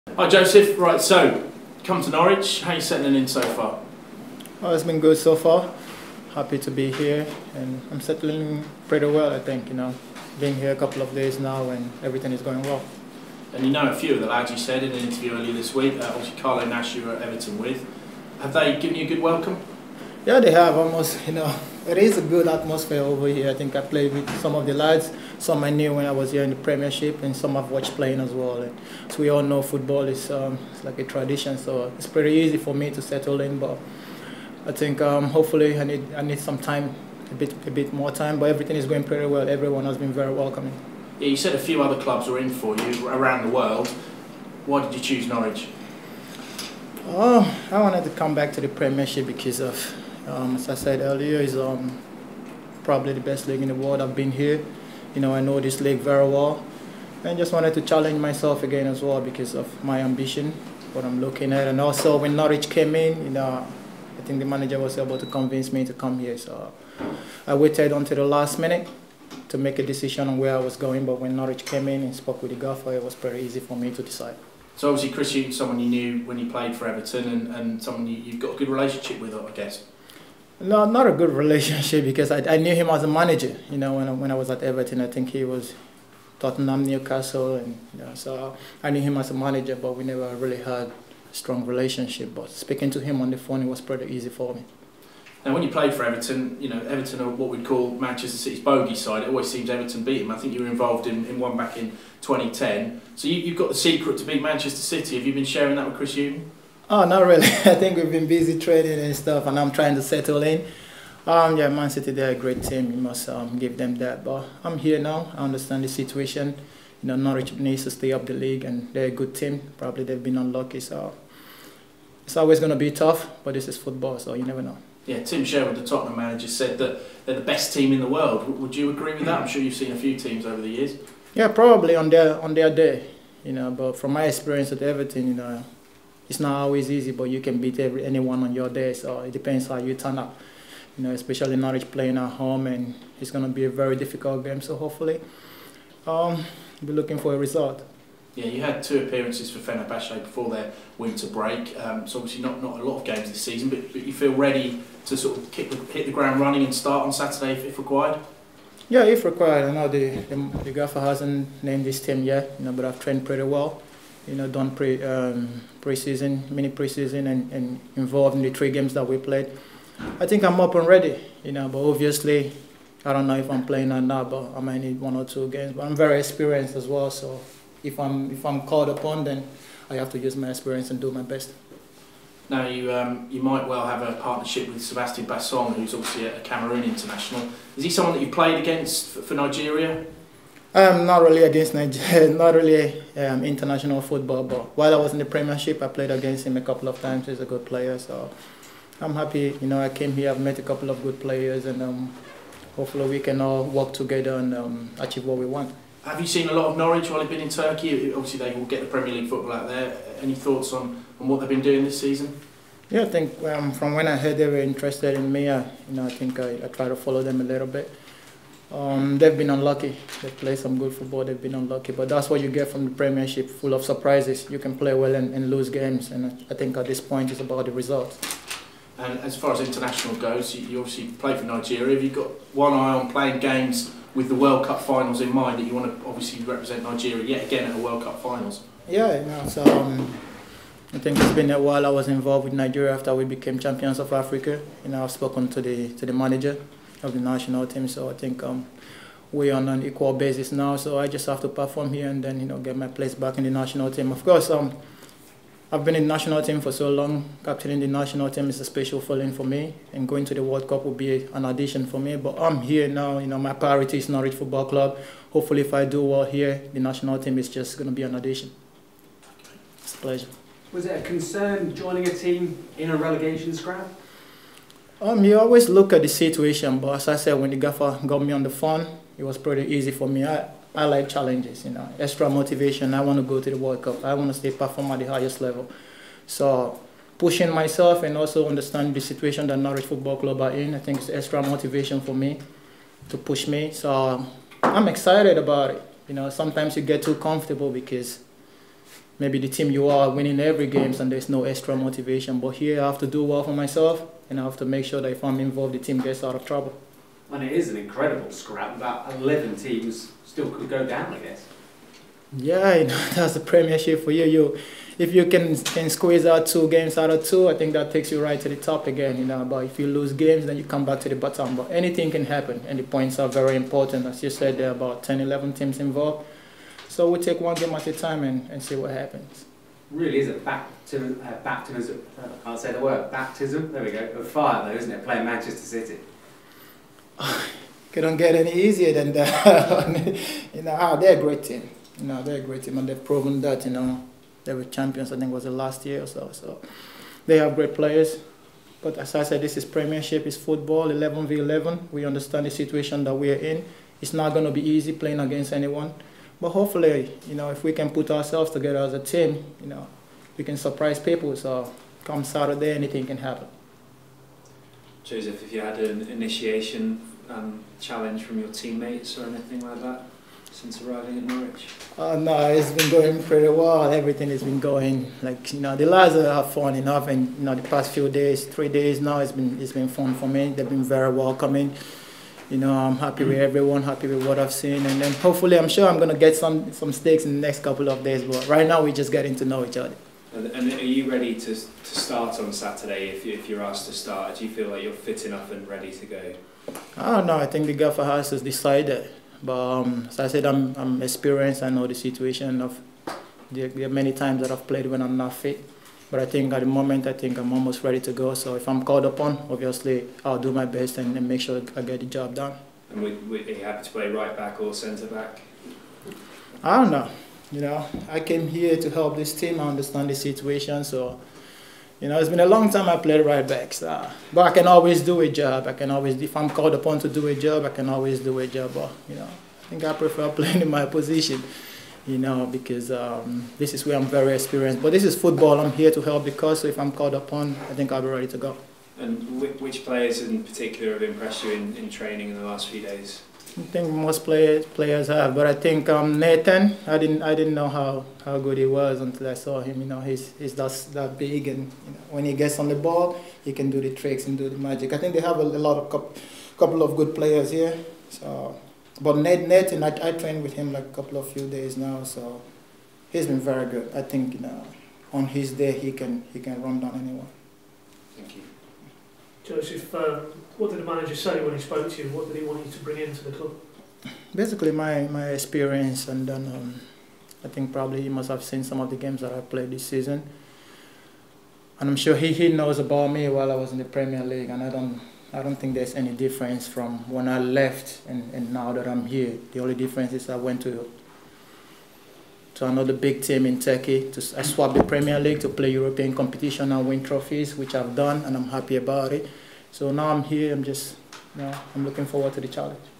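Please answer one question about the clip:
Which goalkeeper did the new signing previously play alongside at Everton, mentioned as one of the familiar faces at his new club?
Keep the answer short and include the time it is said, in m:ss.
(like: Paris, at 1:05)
Carlo Nash, at 0:16.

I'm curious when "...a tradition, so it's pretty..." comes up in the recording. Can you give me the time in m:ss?
0:30.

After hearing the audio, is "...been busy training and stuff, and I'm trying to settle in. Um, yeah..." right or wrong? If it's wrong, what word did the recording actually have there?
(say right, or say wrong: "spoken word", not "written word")
right.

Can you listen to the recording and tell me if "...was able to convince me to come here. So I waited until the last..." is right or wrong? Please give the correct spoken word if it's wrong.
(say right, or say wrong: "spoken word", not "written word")
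right.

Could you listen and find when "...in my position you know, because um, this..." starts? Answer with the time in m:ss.
7:10.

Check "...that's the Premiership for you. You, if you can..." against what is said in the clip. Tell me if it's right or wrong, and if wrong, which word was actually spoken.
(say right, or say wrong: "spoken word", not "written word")
right.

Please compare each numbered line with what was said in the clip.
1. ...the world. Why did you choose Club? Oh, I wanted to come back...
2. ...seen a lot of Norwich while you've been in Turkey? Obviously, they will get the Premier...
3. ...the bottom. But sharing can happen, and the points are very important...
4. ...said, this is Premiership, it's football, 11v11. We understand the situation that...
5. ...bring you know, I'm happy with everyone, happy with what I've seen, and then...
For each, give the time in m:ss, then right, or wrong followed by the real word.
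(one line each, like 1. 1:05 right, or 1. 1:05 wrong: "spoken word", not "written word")
1. 0:43 wrong: "Norwich", not "Club"
2. 3:26 right
3. 5:21 wrong: "anything", not "sharing"
4. 5:49 right
5. 6:21 wrong: "welcoming", not "bring".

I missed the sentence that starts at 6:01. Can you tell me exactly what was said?
So come Saturday, anything can happen.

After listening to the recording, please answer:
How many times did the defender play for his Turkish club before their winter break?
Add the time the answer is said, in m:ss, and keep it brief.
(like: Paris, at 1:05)
2, at 2:28.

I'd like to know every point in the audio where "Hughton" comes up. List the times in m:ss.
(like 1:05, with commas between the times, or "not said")
1:15, 1:46.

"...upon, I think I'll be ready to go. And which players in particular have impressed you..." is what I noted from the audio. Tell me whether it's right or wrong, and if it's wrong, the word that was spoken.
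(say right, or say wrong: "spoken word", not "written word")
right.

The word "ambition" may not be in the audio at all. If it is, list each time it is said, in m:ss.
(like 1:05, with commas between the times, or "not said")
1:00.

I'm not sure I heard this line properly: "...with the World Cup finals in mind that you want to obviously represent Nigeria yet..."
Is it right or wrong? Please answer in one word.
right.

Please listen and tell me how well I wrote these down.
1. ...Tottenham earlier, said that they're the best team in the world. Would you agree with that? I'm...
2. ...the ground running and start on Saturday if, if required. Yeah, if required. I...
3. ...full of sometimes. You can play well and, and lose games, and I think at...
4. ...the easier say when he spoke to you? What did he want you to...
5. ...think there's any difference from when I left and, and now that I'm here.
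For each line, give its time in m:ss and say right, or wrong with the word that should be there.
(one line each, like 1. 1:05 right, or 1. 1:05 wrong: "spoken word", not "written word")
1. 2:05 wrong: "manager", not "earlier"
2. 2:36 right
3. 3:43 wrong: "surprises", not "sometimes"
4. 7:50 wrong: "manager", not "easier"
5. 8:05 right.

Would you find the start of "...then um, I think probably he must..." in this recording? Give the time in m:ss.
7:56.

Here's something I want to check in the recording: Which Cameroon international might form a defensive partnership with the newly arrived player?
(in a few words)
Sebastian Bassong.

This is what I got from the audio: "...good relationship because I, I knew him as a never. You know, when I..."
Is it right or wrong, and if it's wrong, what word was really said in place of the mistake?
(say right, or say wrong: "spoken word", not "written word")
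wrong: "manager", not "never".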